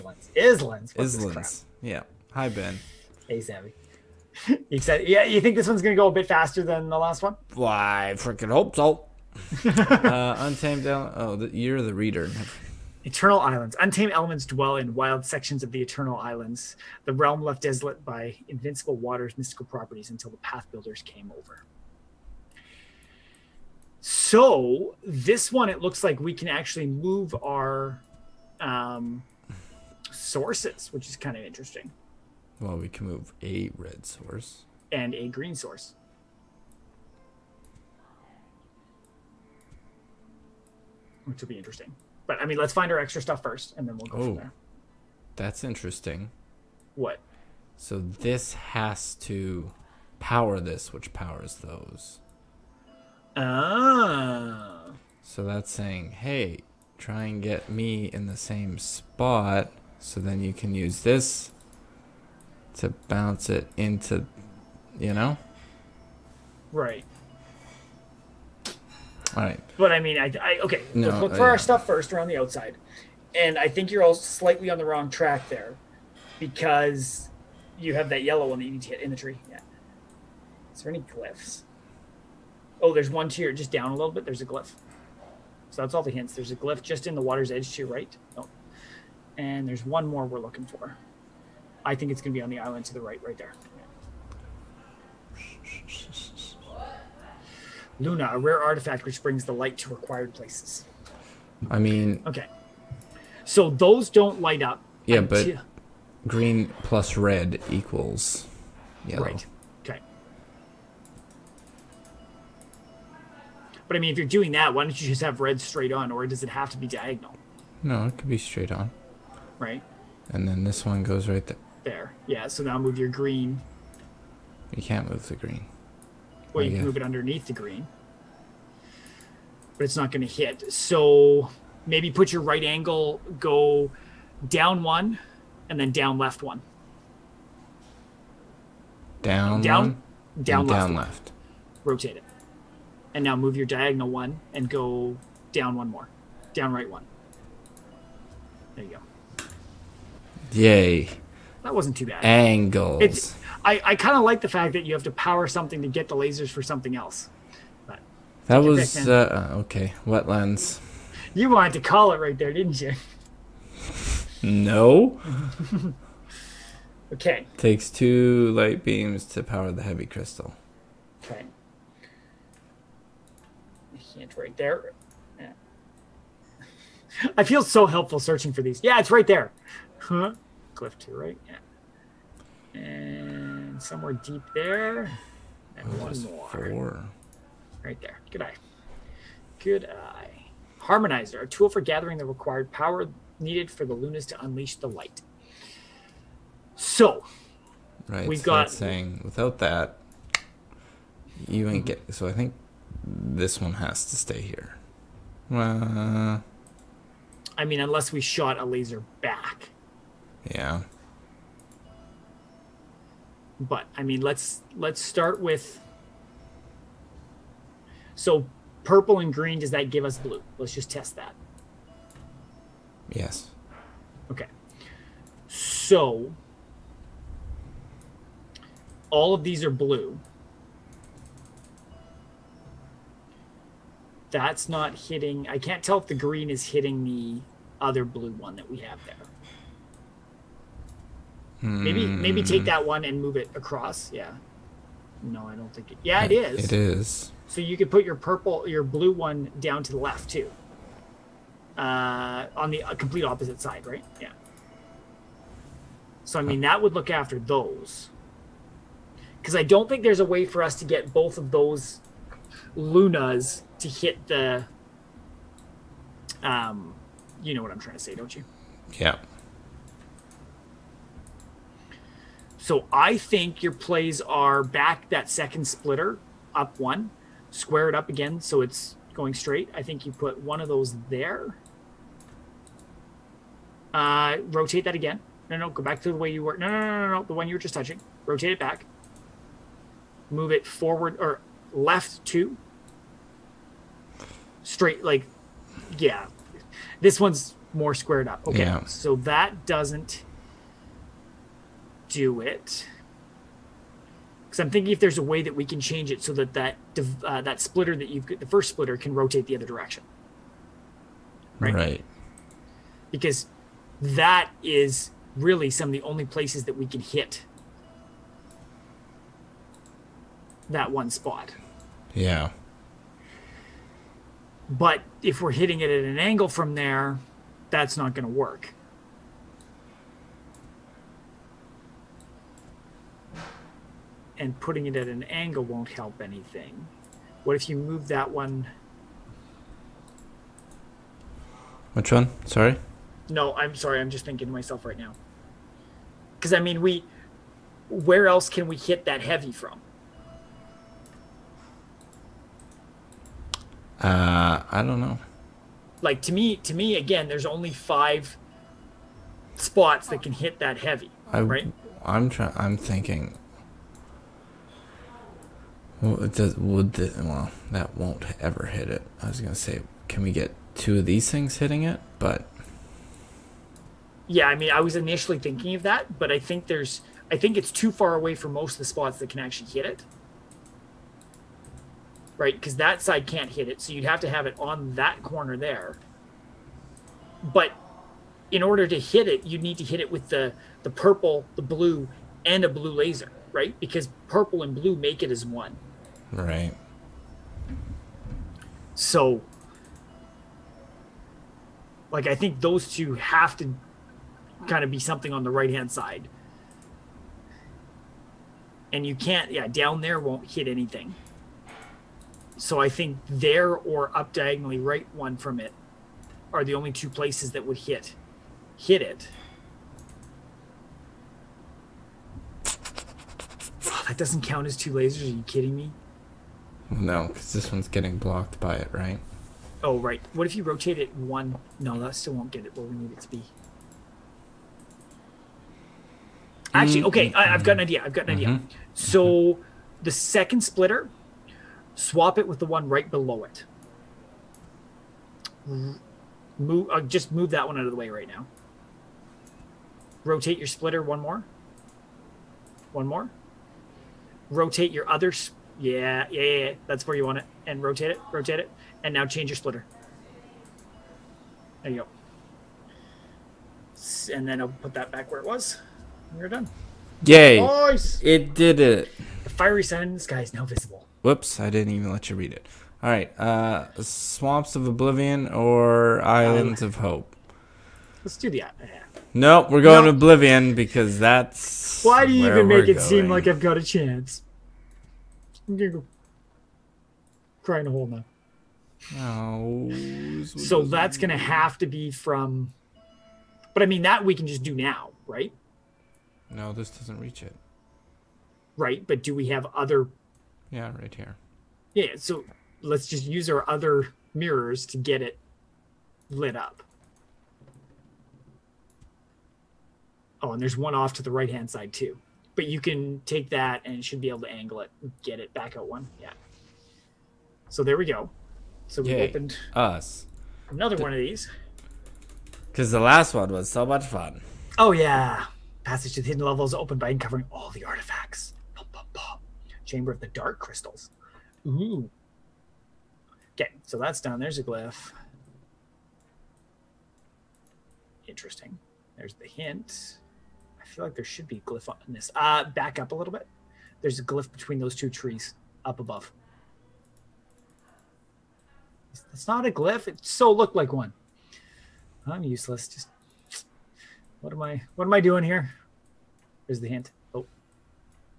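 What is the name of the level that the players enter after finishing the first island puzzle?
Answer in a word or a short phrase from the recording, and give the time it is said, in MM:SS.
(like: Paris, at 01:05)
Wetlands, at 02:40.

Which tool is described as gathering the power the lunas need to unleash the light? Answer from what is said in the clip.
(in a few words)
Harmonizer.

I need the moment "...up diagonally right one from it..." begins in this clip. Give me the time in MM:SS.
06:54.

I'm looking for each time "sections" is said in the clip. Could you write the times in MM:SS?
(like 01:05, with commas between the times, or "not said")
00:15.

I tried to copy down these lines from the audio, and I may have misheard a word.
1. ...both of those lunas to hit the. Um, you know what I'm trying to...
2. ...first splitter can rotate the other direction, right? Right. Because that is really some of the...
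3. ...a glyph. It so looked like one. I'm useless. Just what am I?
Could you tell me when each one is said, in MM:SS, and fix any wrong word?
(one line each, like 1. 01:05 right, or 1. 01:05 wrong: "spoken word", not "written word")
1. 04:21 right
2. 05:08 right
3. 09:09 right.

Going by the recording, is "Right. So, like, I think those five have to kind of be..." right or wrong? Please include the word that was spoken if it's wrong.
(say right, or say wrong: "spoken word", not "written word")
wrong: "two", not "five".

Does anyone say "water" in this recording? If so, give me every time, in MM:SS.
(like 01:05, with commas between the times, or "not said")
00:18, 01:27.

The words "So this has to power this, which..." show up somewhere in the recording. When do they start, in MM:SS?
00:47.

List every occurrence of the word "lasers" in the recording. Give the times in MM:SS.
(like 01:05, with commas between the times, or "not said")
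02:36, 03:28, 06:32, 07:04.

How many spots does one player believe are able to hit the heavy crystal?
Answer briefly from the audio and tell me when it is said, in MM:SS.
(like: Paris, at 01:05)
Five, at 05:57.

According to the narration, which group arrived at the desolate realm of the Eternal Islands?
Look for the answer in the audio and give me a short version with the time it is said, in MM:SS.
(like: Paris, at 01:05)
Path Builders, at 00:20.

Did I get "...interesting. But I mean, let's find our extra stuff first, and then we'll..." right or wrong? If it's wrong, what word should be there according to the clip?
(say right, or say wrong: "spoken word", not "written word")
right.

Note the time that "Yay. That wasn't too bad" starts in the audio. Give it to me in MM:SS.
02:30.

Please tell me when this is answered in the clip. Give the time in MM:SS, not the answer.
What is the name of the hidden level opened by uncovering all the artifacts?
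08:49.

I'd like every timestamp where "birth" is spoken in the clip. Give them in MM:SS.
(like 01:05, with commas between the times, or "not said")
not said.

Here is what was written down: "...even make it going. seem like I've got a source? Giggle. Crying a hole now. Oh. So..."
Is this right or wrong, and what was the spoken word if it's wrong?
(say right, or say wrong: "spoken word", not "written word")
wrong: "chance", not "source".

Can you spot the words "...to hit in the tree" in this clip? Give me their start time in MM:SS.
01:18.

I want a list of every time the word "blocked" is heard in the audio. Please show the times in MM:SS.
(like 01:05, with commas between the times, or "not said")
07:08.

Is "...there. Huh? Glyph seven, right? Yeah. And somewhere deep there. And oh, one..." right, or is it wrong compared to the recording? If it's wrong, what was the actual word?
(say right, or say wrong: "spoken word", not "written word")
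wrong: "two", not "seven".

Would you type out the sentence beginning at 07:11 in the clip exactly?
No, that still won't get it where we need it to be.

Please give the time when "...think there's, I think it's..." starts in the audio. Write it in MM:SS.
06:16.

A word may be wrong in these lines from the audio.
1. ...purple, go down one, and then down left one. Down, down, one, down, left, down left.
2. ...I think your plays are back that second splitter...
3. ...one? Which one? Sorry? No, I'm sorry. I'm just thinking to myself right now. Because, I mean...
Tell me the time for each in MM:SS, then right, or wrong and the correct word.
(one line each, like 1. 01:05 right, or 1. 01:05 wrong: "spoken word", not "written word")
1. 02:12 wrong: "angle", not "purple"
2. 04:32 right
3. 05:38 right.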